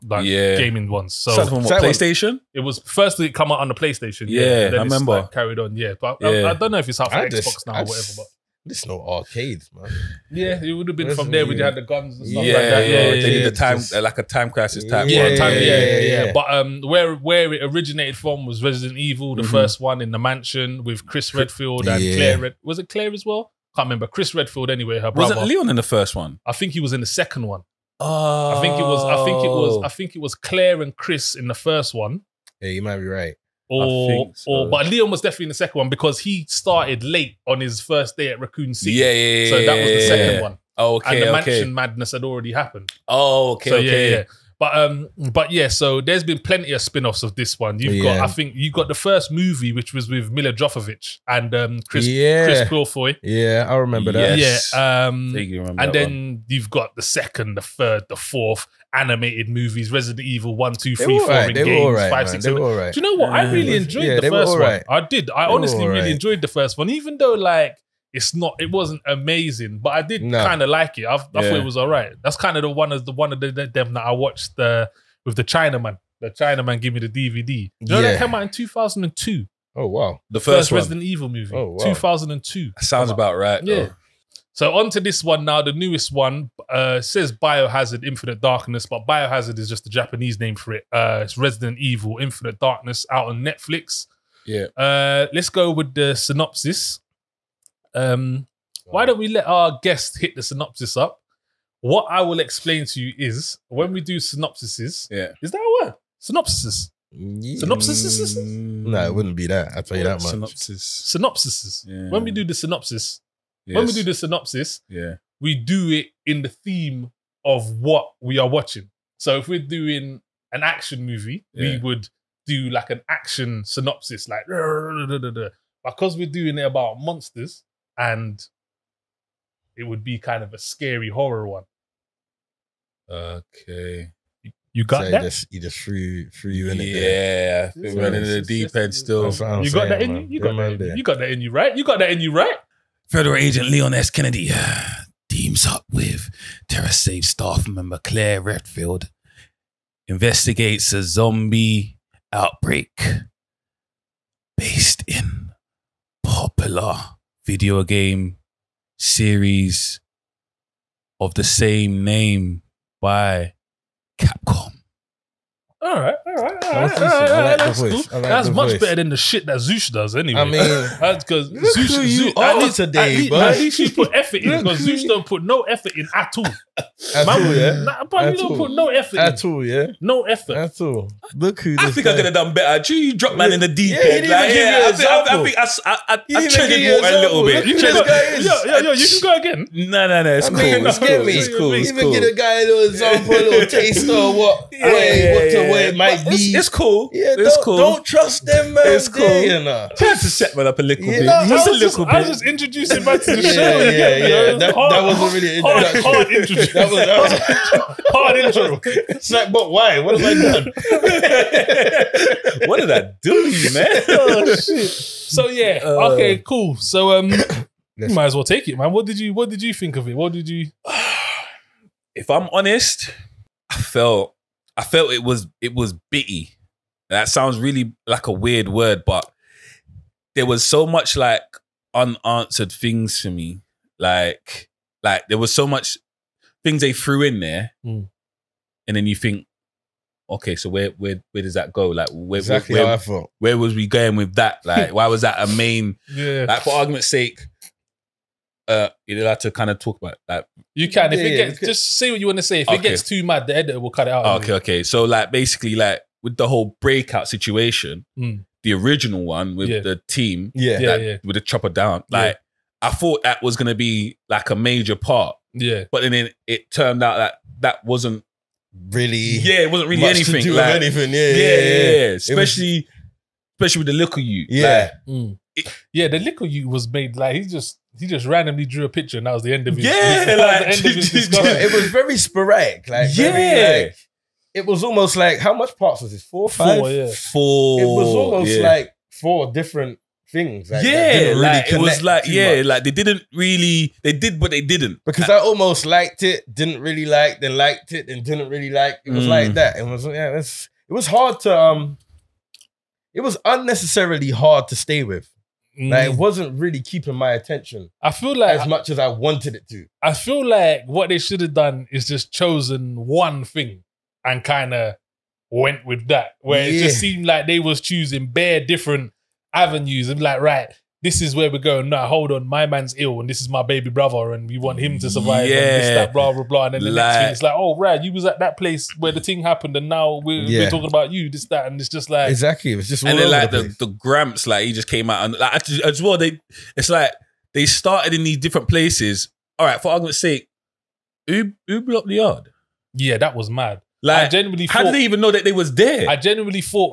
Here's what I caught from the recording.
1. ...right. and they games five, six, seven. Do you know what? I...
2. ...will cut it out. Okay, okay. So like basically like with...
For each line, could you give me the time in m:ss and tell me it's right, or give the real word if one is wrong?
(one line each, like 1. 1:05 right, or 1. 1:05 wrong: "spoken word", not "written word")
1. 1:01 right
2. 4:13 right.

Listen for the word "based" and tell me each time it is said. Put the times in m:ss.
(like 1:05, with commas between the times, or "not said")
2:34.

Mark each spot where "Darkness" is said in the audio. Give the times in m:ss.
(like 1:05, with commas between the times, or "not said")
1:28, 1:32.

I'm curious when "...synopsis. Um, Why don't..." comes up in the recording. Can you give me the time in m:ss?
1:36.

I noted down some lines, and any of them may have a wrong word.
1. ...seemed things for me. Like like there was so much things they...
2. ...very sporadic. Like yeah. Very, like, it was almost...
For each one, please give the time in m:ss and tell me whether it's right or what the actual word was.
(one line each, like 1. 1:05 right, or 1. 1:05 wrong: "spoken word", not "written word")
1. 3:51 wrong: "unanswered", not "seemed"
2. 4:41 right.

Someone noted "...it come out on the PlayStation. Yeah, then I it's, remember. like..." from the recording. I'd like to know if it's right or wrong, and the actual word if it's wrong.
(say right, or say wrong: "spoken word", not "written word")
right.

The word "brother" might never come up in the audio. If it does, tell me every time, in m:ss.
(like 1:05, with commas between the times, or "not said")
0:25, 5:23.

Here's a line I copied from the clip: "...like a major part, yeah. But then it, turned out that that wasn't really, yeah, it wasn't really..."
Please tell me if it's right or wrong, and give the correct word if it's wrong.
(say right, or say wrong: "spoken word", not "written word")
right.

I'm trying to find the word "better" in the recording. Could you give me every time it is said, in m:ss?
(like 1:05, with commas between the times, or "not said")
2:48, 3:02.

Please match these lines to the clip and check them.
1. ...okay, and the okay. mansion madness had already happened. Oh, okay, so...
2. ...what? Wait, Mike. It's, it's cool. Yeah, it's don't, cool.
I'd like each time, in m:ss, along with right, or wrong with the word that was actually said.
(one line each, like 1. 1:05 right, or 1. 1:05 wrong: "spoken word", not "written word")
1. 0:40 right
2. 3:15 right.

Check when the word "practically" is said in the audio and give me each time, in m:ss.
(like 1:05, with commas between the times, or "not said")
not said.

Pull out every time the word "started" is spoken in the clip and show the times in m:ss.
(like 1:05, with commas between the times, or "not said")
0:36, 5:37.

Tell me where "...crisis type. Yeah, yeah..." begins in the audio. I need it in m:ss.
0:14.